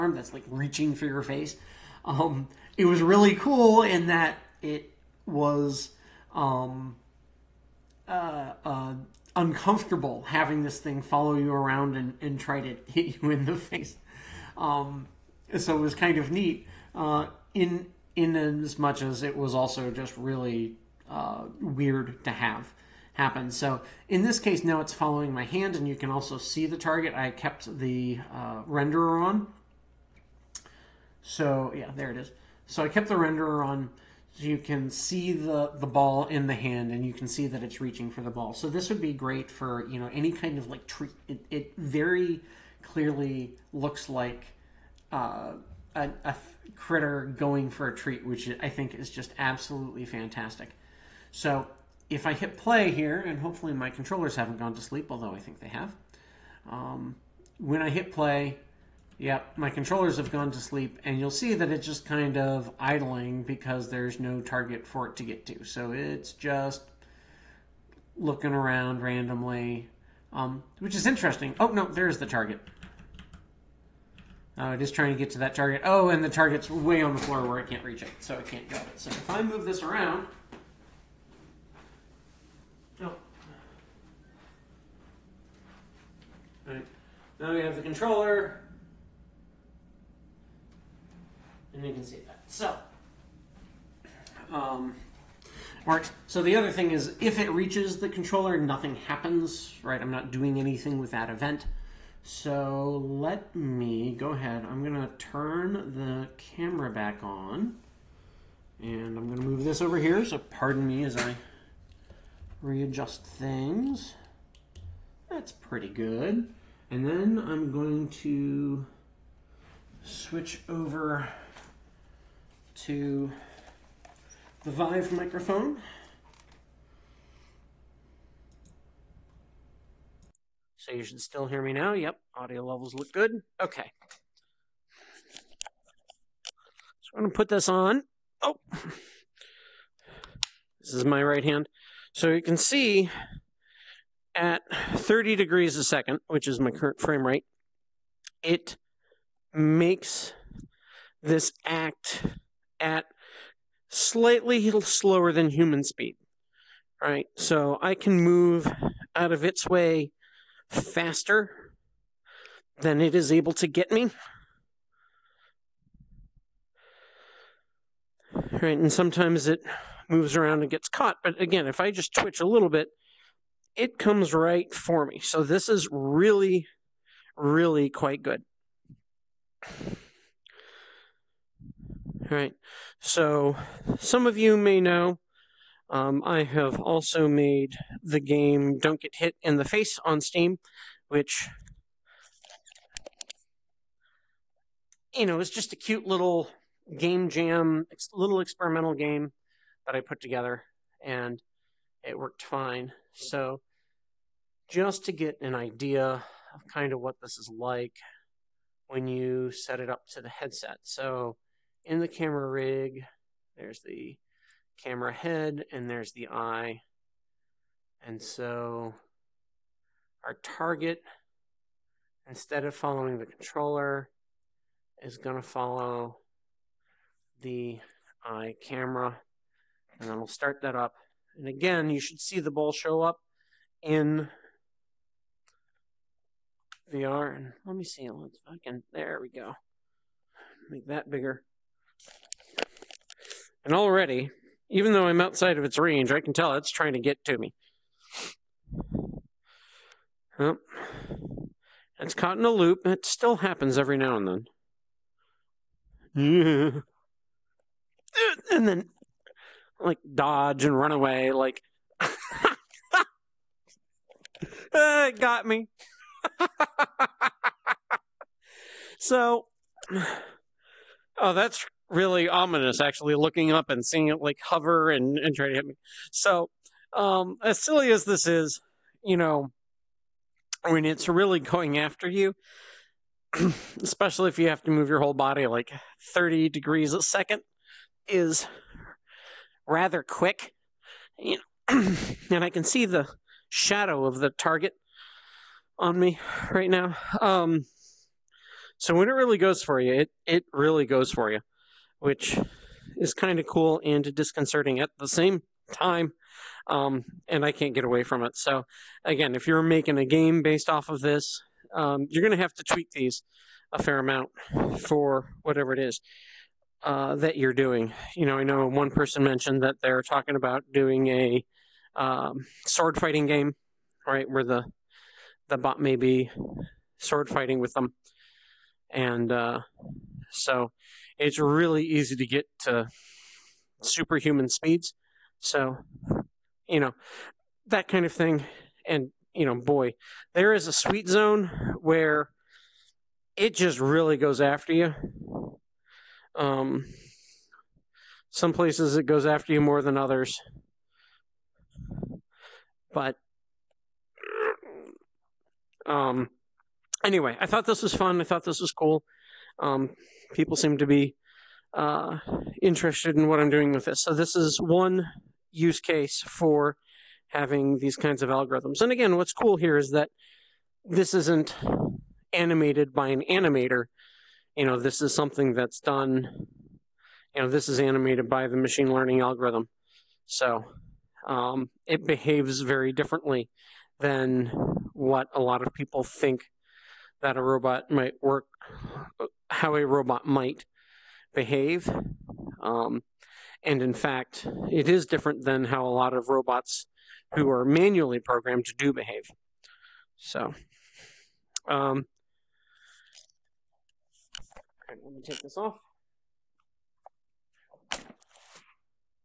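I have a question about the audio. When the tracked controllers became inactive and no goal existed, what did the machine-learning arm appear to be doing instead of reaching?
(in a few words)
Idling.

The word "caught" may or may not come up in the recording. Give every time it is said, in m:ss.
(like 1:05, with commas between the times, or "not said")
2:50, 4:12.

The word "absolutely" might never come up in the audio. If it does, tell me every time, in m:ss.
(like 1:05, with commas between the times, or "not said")
0:49.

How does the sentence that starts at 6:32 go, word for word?
Um, and in fact, it is different than how a lot of robots who are manually programmed do behave.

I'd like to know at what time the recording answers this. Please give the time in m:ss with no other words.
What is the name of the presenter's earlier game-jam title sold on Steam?
3:08.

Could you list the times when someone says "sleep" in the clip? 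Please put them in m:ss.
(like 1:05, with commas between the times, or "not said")
0:54, 1:00.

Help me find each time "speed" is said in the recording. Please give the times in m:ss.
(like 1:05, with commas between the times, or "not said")
2:35, 5:34.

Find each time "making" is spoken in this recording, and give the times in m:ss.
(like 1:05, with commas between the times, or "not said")
5:09.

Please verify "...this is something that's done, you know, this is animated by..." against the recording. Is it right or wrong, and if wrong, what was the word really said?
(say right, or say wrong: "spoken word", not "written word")
right.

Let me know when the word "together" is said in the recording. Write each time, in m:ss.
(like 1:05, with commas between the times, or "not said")
3:20.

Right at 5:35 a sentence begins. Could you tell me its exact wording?
So, you know, that kind of thing.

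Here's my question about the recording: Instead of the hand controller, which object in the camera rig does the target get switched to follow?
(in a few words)
The eye camera.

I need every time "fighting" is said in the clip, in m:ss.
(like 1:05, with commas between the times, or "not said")
5:22, 5:27.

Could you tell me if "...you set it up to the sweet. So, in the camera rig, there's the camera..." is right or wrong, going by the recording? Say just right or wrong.
wrong.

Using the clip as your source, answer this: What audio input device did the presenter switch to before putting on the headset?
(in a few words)
Vive microphone.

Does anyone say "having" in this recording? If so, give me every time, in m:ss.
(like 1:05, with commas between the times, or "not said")
0:10, 6:07.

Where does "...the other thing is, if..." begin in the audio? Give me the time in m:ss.
1:36.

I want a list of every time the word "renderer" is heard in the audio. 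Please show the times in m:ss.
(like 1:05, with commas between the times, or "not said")
0:28, 0:33.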